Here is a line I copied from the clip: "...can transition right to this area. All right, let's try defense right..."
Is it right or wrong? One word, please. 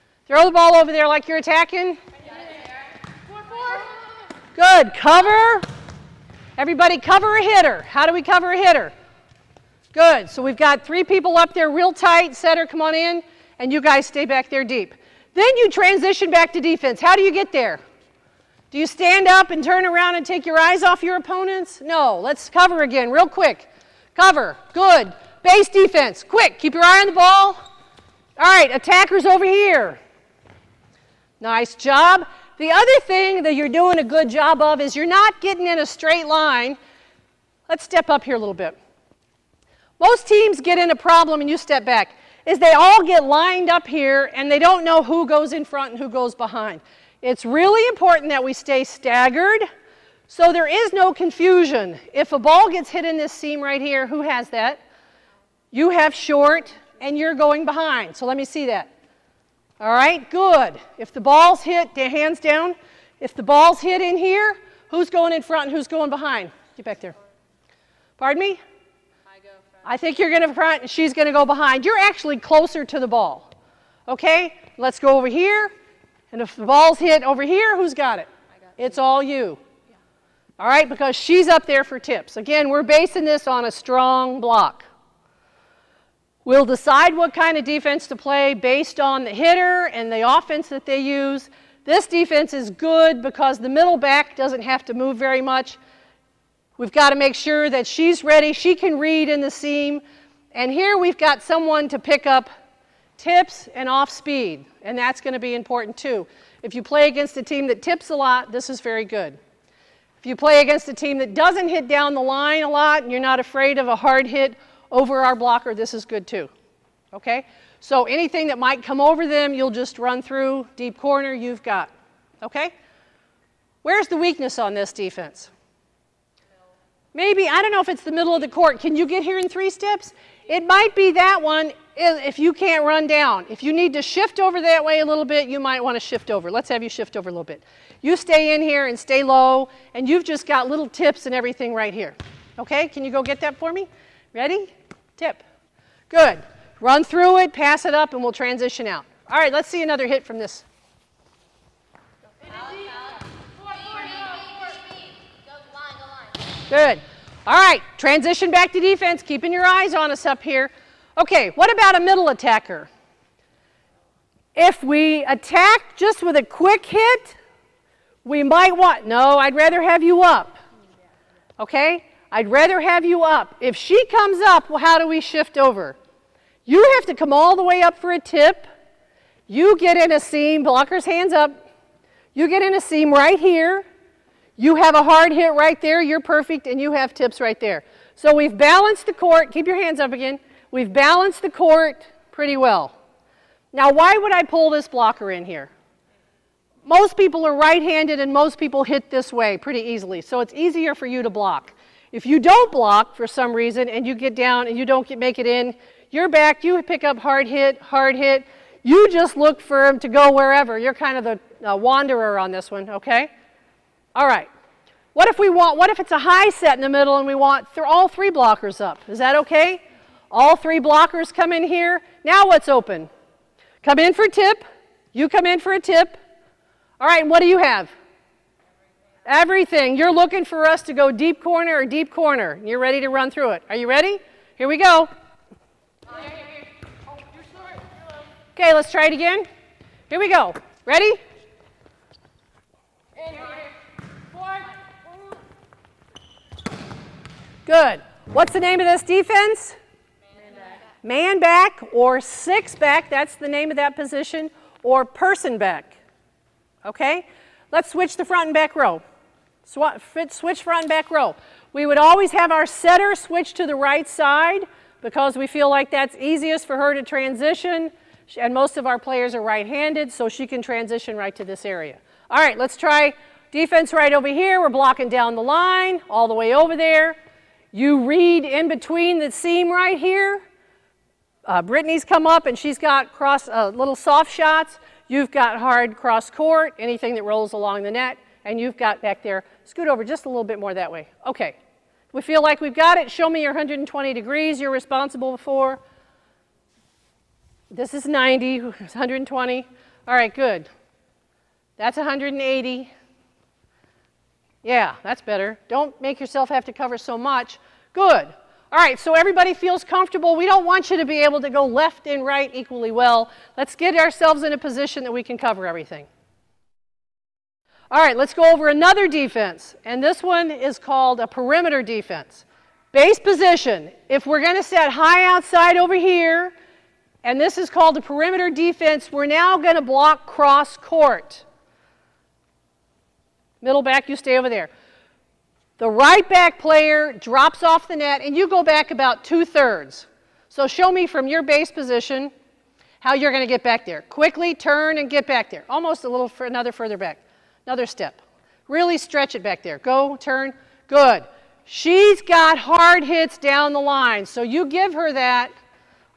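right.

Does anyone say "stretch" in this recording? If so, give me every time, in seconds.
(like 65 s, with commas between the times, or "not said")
348 s.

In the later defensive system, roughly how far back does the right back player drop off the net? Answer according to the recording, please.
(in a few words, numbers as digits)
Two-thirds.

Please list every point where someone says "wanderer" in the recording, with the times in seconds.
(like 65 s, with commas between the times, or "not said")
211 s.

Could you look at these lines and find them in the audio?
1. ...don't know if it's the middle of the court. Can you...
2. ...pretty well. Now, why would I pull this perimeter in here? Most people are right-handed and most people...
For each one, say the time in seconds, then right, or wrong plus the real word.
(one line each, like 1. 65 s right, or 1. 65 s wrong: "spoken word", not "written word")
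1. 127 s right
2. 192 s wrong: "blocker", not "perimeter".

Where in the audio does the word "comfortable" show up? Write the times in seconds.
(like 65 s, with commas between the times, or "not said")
309 s.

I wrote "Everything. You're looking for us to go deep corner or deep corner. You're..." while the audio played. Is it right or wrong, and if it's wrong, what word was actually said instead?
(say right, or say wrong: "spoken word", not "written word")
right.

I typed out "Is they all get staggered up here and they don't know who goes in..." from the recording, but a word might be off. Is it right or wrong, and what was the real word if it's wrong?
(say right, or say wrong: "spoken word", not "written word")
wrong: "lined", not "staggered".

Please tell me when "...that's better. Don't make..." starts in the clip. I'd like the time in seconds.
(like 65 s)
305 s.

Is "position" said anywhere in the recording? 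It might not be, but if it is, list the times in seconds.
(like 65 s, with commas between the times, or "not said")
253 s, 314 s, 323 s, 341 s.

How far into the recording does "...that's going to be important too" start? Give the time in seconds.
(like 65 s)
104 s.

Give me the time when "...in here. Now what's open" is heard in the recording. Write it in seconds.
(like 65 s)
221 s.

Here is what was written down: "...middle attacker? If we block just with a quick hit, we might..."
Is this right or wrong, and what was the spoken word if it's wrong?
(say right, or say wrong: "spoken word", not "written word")
wrong: "attack", not "block".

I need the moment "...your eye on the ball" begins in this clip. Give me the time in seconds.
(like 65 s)
26 s.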